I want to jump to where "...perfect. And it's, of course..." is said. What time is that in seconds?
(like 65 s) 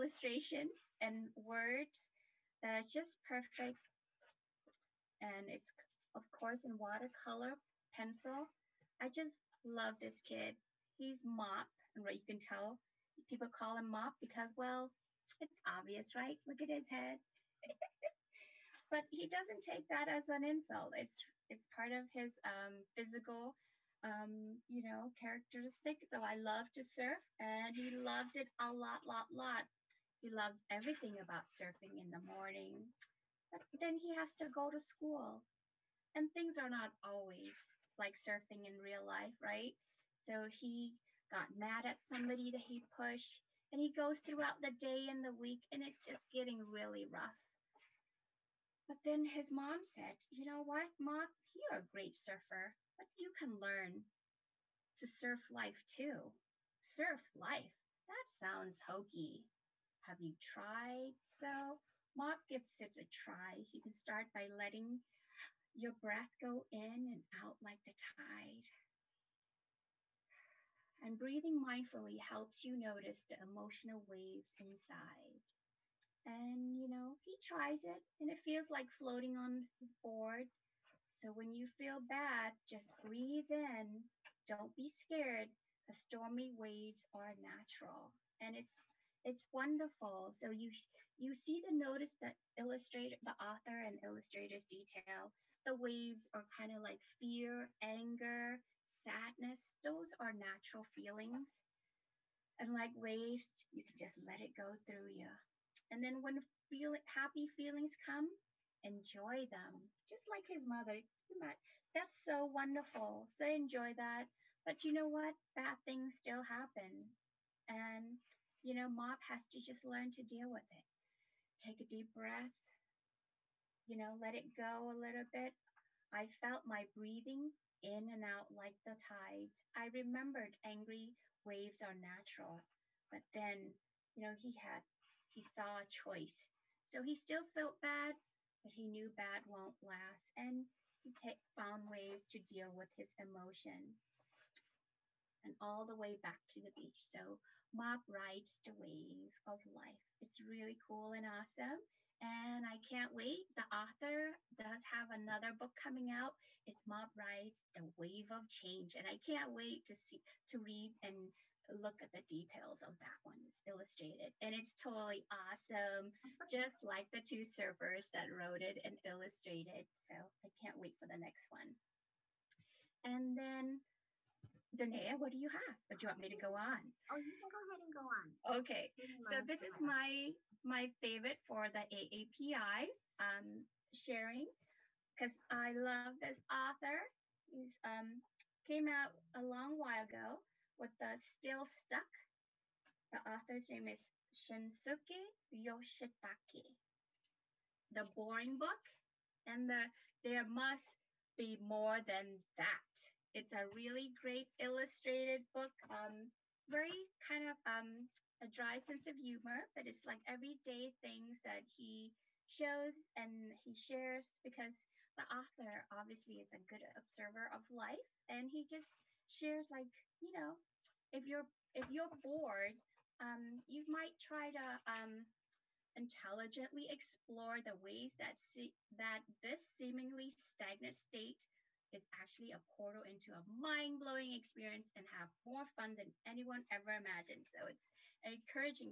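3 s.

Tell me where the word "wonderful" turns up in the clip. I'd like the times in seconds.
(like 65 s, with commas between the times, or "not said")
89 s, 112 s.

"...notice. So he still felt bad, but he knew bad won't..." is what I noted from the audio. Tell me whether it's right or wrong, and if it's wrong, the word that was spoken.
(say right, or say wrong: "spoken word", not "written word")
wrong: "choice", not "notice".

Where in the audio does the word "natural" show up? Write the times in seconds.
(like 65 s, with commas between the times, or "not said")
87 s, 100 s, 131 s.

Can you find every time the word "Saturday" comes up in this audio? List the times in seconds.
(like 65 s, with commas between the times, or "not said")
not said.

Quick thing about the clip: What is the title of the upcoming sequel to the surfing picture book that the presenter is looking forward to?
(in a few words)
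Mop Rides the Wave of Change.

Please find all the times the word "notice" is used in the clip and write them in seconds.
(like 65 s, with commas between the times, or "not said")
72 s, 91 s.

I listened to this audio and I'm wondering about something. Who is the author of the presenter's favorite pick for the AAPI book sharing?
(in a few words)
Shinsuke Yoshitake.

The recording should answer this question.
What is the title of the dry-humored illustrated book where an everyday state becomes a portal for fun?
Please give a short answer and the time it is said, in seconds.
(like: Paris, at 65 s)
The Boring Book, at 197 s.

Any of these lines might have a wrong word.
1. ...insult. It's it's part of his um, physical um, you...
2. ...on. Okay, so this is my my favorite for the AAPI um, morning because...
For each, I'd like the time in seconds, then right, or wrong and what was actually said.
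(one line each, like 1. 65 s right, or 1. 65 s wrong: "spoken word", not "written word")
1. 20 s right
2. 178 s wrong: "sharing", not "morning".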